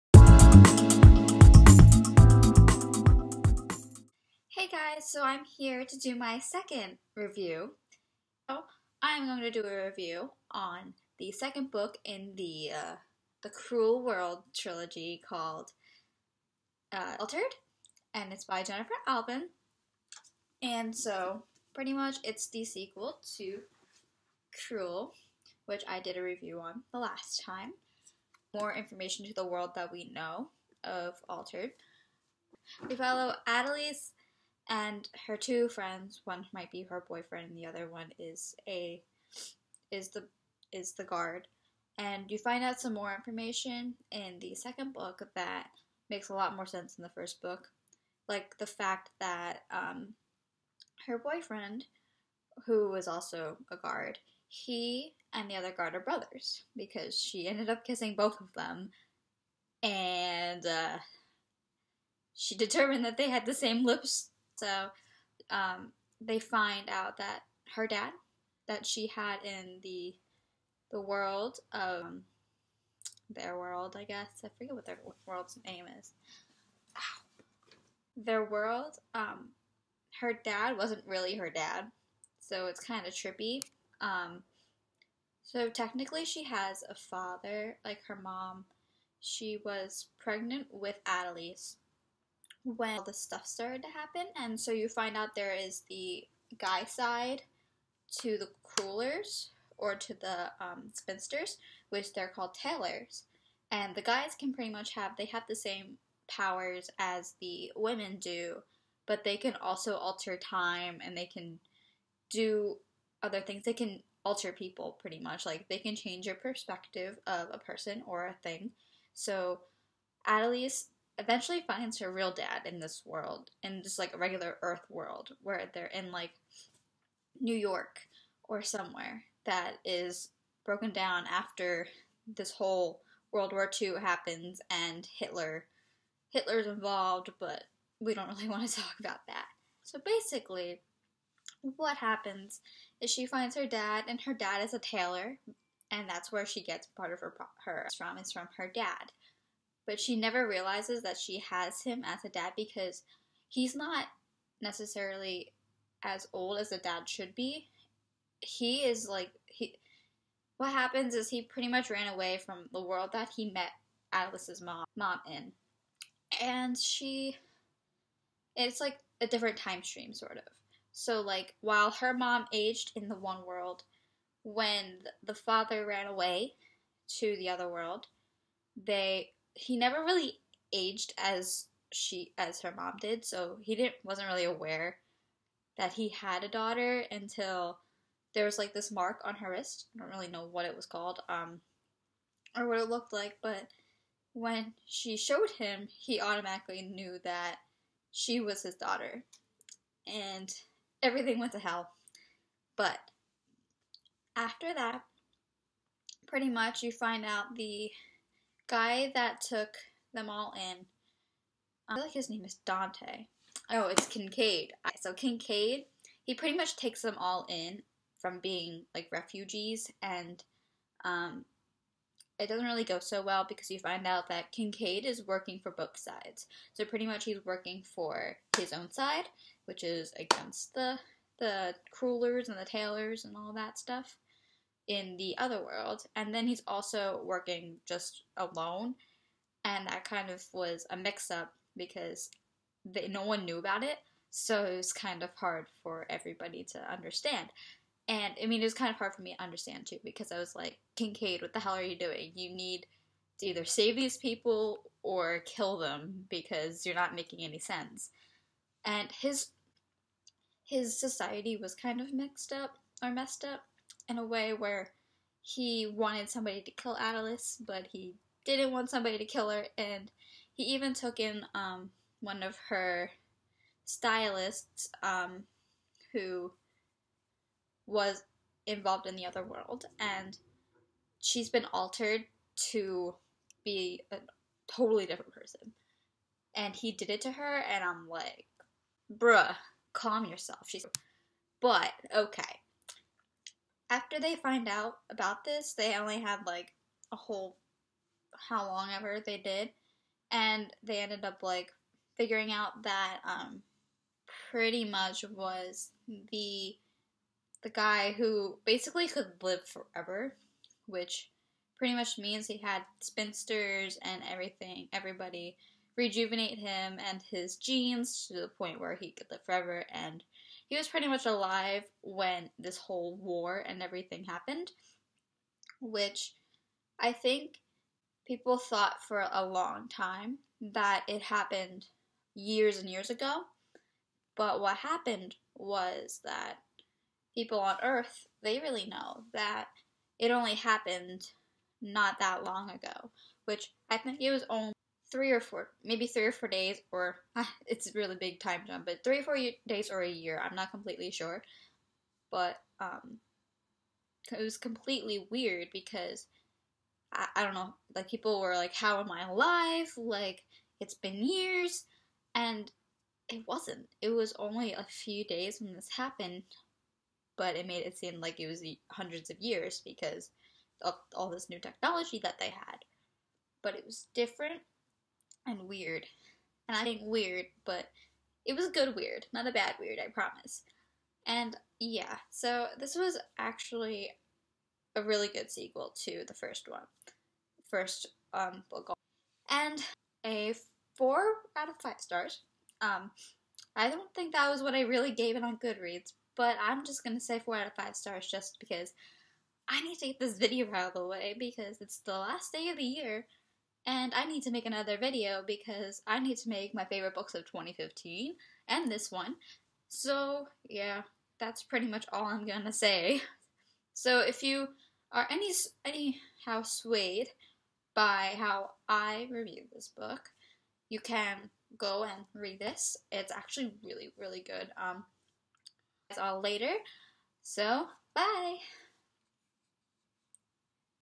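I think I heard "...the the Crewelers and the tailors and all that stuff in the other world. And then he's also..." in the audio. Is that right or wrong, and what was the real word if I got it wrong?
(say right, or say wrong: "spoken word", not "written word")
right.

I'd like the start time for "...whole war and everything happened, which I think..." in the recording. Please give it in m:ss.
5:22.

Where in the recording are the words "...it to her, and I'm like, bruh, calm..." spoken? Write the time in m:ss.
4:47.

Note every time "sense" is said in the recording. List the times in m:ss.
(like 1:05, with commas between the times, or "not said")
0:46, 4:17.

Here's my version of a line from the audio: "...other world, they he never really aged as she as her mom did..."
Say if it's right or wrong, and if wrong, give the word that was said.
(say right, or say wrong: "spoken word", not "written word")
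right.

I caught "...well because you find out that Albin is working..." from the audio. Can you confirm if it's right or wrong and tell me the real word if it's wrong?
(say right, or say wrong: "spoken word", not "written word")
wrong: "Kincaid", not "Albin".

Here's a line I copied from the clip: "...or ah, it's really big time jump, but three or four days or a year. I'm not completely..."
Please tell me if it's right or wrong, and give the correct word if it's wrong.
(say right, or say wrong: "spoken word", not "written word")
right.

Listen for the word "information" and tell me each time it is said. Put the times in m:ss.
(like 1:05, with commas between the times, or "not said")
0:28, 0:43.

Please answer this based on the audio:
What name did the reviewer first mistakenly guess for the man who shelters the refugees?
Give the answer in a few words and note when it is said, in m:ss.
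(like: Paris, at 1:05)
Dante, at 3:32.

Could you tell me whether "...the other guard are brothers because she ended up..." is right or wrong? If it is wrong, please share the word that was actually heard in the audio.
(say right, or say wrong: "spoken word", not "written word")
right.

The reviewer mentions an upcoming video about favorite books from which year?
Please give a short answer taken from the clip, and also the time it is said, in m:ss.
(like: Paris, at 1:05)
2015, at 6:47.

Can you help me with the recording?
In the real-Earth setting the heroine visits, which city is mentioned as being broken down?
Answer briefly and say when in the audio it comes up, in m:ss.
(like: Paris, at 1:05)
New York, at 2:07.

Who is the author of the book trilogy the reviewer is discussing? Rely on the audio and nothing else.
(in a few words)
Gennifer Albin.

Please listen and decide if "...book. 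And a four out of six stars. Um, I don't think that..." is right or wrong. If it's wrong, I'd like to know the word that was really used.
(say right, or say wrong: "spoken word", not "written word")
wrong: "five", not "six".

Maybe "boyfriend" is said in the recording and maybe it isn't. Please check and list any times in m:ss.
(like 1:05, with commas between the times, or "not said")
0:37, 0:51.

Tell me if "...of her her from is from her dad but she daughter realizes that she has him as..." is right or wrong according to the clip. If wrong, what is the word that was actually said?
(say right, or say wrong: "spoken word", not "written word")
wrong: "never", not "daughter".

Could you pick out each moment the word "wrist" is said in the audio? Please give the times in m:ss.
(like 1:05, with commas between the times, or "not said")
3:09.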